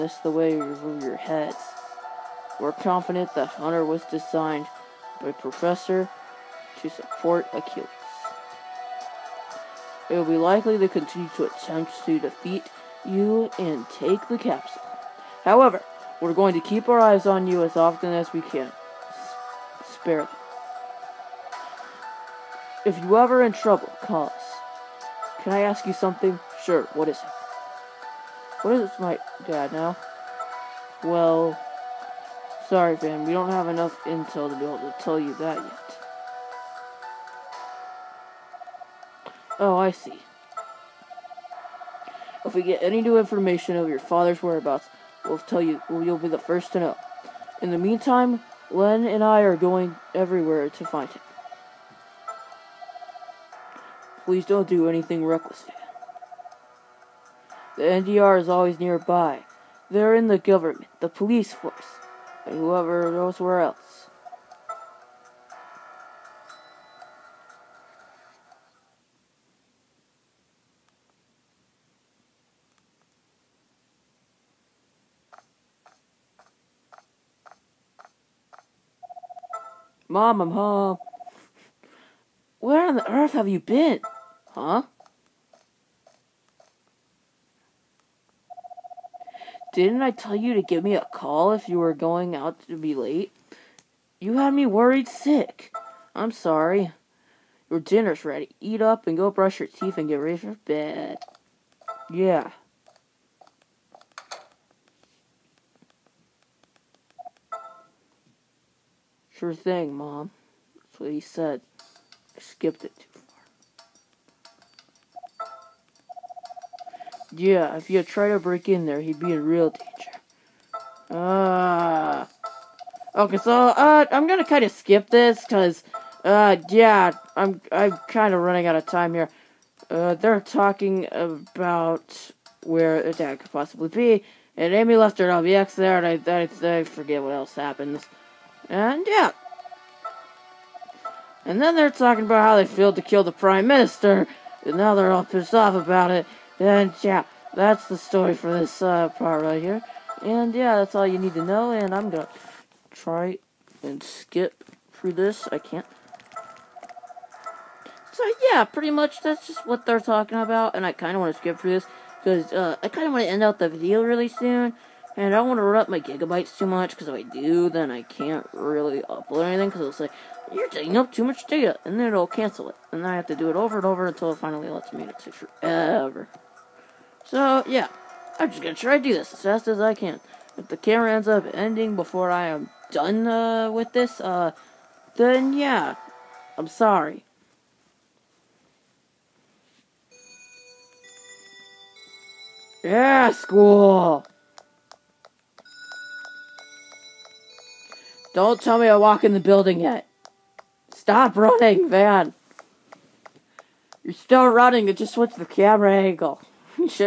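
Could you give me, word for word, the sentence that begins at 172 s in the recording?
And then I have to do it over and over until it finally lets me, and it takes forever.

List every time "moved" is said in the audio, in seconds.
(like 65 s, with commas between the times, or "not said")
not said.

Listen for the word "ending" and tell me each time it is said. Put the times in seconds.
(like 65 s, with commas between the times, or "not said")
181 s.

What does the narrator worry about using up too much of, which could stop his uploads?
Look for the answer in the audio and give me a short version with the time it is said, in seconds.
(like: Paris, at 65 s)
gigabytes, at 165 s.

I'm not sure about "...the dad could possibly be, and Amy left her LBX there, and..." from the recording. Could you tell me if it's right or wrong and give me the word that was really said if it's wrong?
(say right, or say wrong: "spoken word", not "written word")
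right.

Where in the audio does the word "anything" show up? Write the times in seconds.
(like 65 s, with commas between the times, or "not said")
54 s, 169 s.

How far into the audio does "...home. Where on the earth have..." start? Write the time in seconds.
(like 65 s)
80 s.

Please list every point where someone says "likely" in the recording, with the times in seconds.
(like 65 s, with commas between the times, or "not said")
10 s.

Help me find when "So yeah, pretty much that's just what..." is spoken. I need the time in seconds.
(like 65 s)
158 s.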